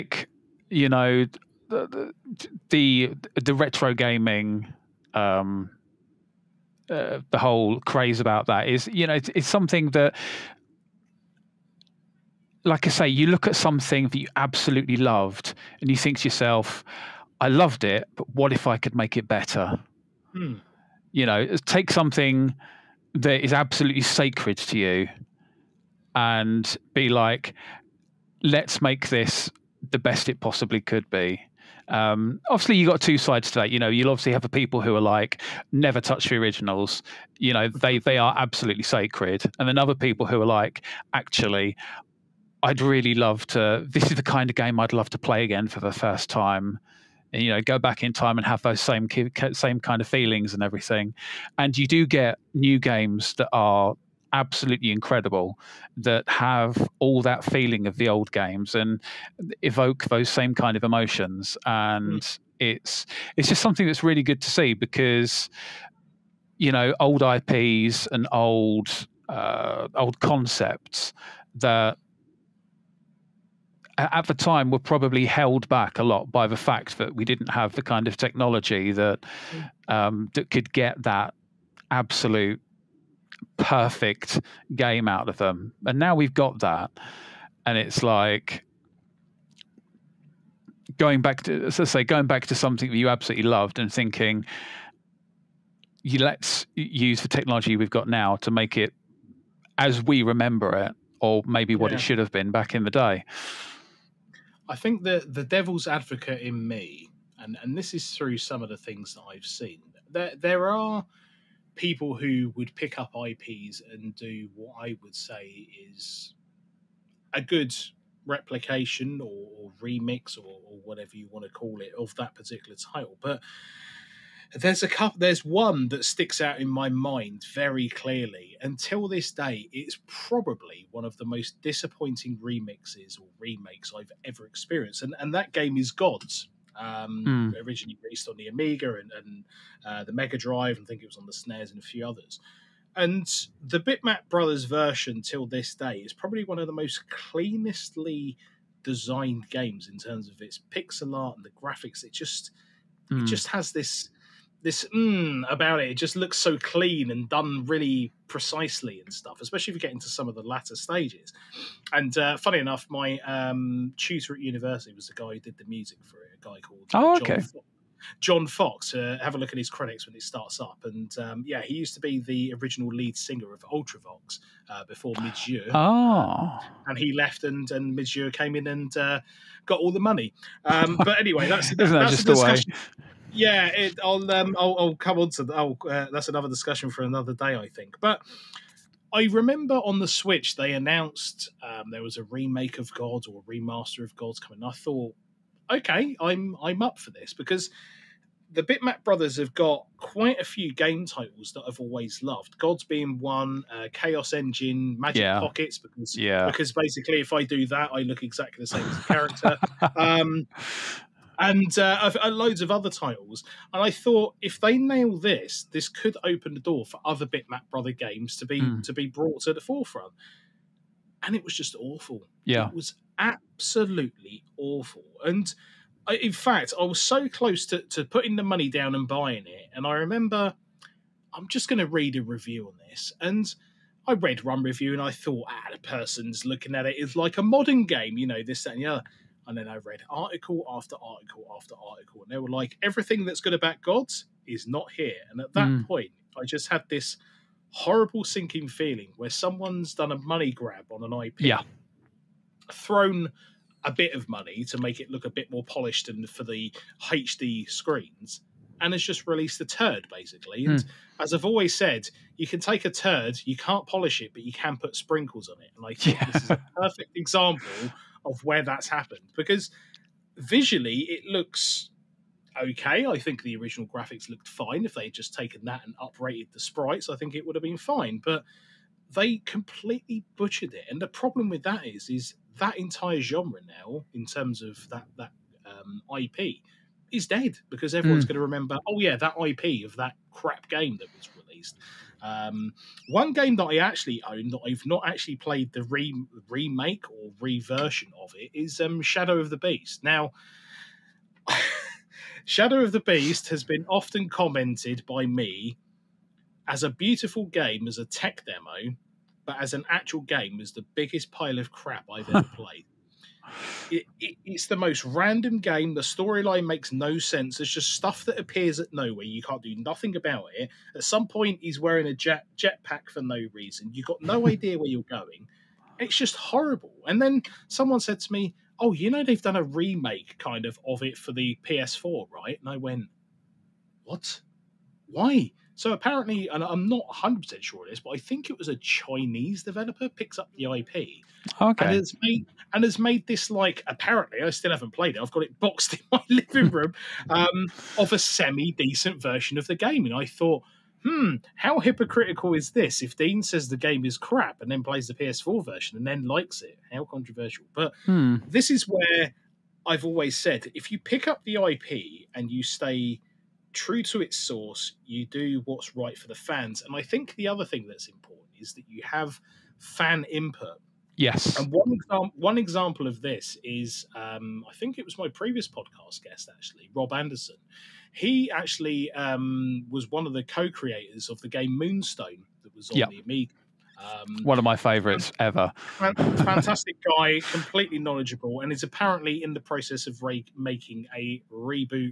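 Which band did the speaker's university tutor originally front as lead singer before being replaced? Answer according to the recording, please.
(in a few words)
Ultravox.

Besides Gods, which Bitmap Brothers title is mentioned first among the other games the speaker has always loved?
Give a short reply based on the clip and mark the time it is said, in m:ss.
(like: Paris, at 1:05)
Chaos Engine, at 3:23.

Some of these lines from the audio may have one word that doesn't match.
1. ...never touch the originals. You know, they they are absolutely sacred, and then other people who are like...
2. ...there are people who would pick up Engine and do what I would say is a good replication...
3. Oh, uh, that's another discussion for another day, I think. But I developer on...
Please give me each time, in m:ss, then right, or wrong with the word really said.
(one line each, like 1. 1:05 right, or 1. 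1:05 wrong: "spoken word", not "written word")
1. 0:35 right
2. 1:50 wrong: "IPs", not "Engine"
3. 3:05 wrong: "remember", not "developer".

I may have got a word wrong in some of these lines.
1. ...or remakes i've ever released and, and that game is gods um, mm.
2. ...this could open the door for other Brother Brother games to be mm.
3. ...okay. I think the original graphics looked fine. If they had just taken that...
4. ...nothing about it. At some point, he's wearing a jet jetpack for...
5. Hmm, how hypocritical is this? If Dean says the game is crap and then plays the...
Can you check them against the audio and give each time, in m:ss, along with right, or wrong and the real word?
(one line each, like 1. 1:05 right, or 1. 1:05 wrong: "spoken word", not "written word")
1. 2:13 wrong: "experienced", not "released"
2. 3:35 wrong: "Bitmap", not "Brother"
3. 4:32 right
4. 5:19 right
5. 5:51 right.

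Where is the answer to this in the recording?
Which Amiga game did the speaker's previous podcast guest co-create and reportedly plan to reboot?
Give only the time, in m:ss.
6:21.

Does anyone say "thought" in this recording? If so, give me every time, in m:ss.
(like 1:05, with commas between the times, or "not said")
3:14, 3:33, 3:55, 5:50.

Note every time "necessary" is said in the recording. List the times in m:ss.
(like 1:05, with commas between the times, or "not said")
not said.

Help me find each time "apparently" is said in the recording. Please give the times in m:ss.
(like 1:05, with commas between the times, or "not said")
5:35, 5:43, 6:28.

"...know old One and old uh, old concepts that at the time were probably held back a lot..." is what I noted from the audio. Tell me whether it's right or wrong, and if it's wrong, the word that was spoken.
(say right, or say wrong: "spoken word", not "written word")
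wrong: "IPs", not "One".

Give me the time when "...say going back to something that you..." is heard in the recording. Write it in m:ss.
1:31.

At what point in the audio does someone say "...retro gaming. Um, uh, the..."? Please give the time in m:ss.
0:03.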